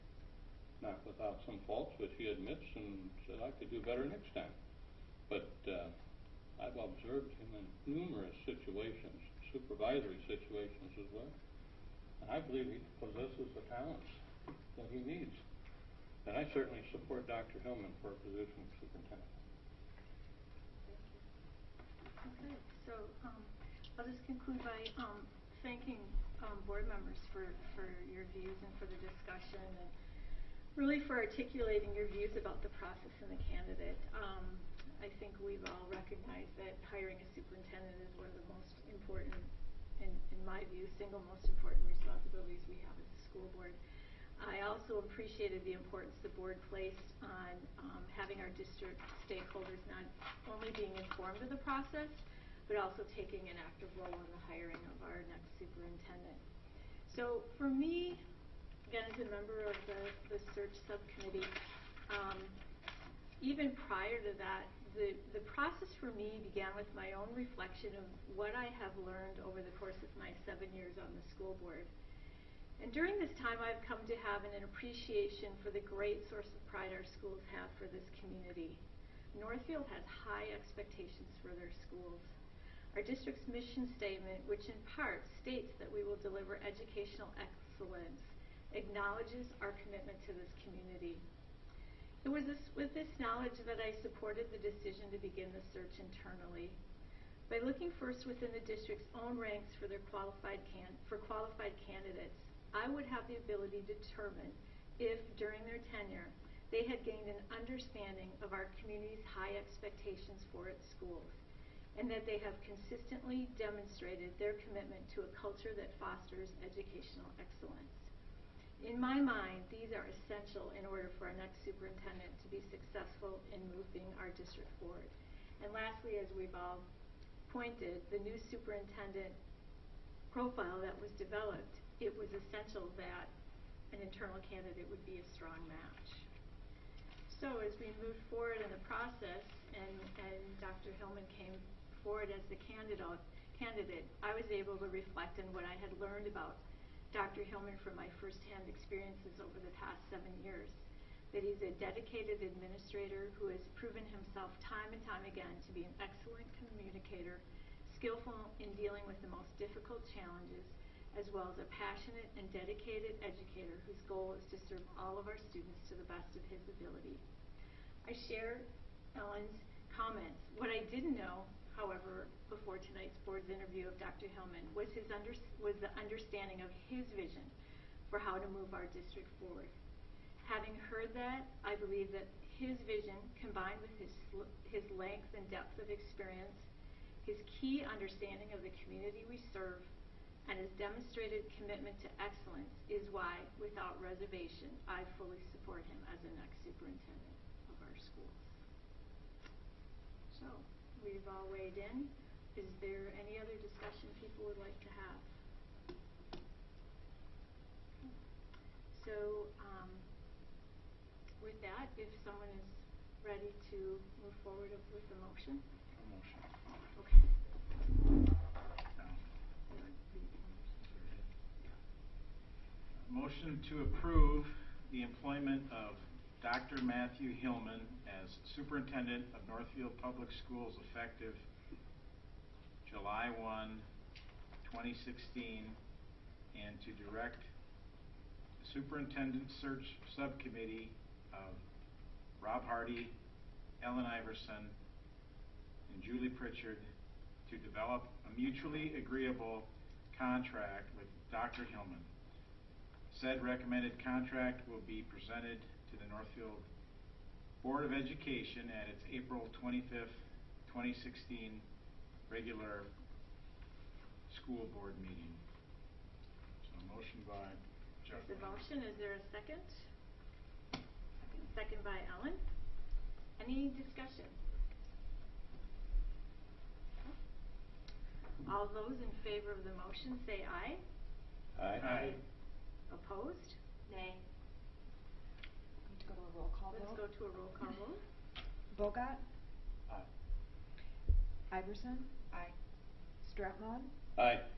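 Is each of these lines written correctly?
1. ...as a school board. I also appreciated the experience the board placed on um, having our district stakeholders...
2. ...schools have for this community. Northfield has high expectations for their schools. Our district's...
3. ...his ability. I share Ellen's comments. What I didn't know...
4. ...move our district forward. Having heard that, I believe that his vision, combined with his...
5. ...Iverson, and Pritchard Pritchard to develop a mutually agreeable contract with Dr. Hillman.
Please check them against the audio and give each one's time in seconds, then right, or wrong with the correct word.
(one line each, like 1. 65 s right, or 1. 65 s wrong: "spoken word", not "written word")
1. 42 s wrong: "importance", not "experience"
2. 77 s right
3. 166 s right
4. 178 s right
5. 244 s wrong: "Julie", not "Pritchard".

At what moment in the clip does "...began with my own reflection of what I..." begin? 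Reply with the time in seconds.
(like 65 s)
66 s.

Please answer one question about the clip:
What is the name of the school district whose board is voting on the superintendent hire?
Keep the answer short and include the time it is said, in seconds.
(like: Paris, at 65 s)
Northfield Public Schools, at 229 s.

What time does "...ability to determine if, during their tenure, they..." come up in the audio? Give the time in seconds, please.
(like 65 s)
103 s.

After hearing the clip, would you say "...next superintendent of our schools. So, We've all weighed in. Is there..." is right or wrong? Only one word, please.
right.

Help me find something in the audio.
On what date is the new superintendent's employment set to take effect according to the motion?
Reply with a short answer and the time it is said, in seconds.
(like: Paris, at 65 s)
July 1, 2016, at 232 s.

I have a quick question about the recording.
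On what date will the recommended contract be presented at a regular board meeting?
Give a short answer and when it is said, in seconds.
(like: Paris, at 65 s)
April 25th, 2016, at 259 s.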